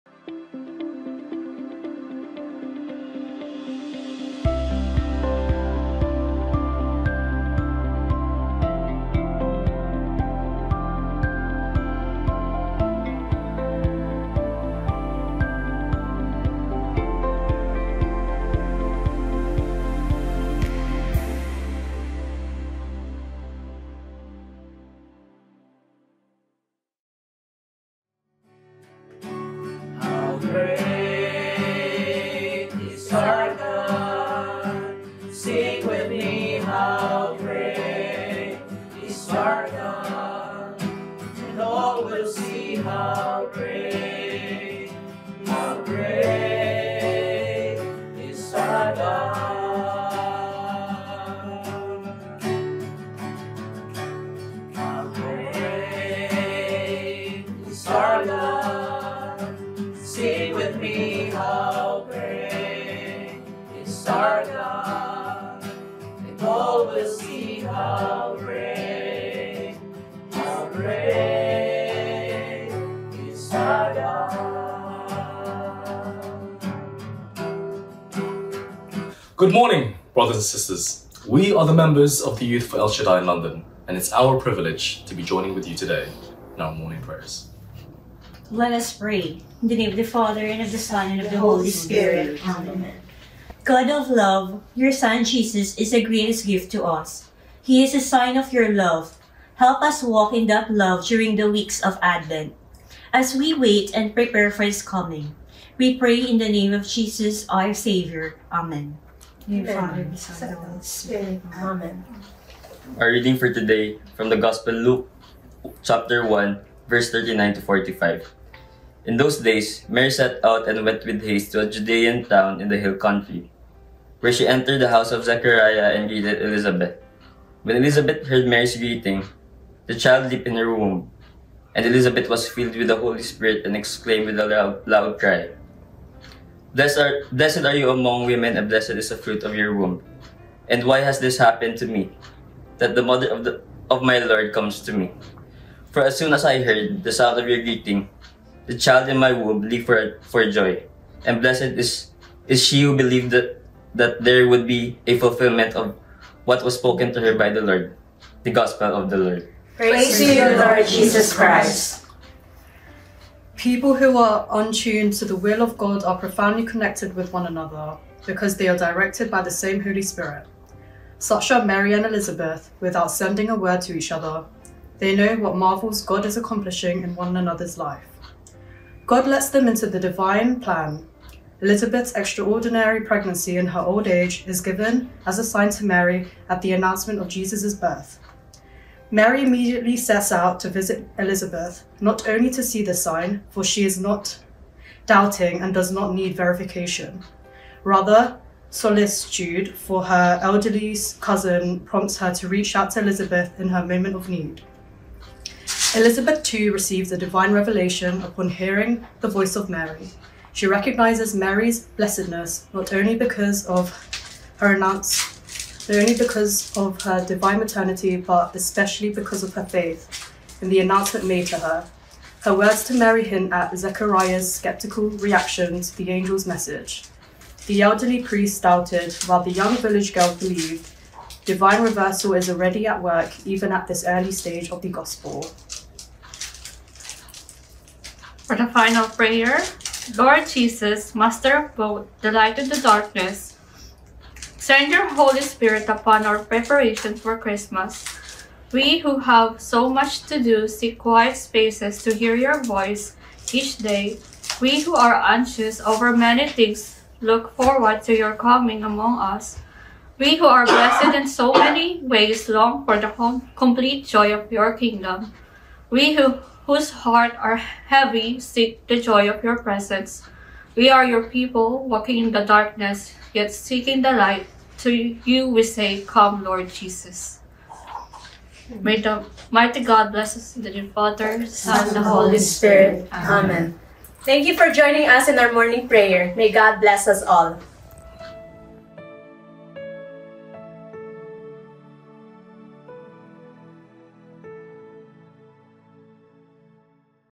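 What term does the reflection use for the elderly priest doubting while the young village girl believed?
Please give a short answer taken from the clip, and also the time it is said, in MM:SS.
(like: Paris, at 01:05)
Divine reversal, at 03:51.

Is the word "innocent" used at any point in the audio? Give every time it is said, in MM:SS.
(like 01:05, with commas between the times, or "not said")
not said.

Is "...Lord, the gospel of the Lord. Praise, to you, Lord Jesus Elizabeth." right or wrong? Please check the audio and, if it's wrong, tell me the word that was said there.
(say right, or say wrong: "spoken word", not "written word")
wrong: "Christ", not "Elizabeth".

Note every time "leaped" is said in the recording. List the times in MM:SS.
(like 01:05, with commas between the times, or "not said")
02:10, 02:29.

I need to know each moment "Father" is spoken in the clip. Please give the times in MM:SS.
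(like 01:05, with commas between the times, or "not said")
01:30, 04:40.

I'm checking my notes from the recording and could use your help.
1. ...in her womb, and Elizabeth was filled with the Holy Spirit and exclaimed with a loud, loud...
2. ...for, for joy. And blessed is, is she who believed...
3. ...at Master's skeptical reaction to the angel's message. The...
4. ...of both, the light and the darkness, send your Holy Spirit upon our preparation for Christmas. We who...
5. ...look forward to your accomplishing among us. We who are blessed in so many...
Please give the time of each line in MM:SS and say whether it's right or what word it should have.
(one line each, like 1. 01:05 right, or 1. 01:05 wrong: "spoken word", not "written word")
1. 02:10 right
2. 02:29 right
3. 03:43 wrong: "Zechariah", not "Master"
4. 04:01 right
5. 04:17 wrong: "coming", not "accomplishing".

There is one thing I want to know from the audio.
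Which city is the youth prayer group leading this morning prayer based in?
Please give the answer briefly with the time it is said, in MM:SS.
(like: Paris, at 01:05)
London, at 01:23.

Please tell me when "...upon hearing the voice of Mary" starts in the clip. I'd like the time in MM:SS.
03:28.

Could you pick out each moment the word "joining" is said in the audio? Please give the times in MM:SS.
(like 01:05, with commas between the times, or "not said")
01:25, 04:44.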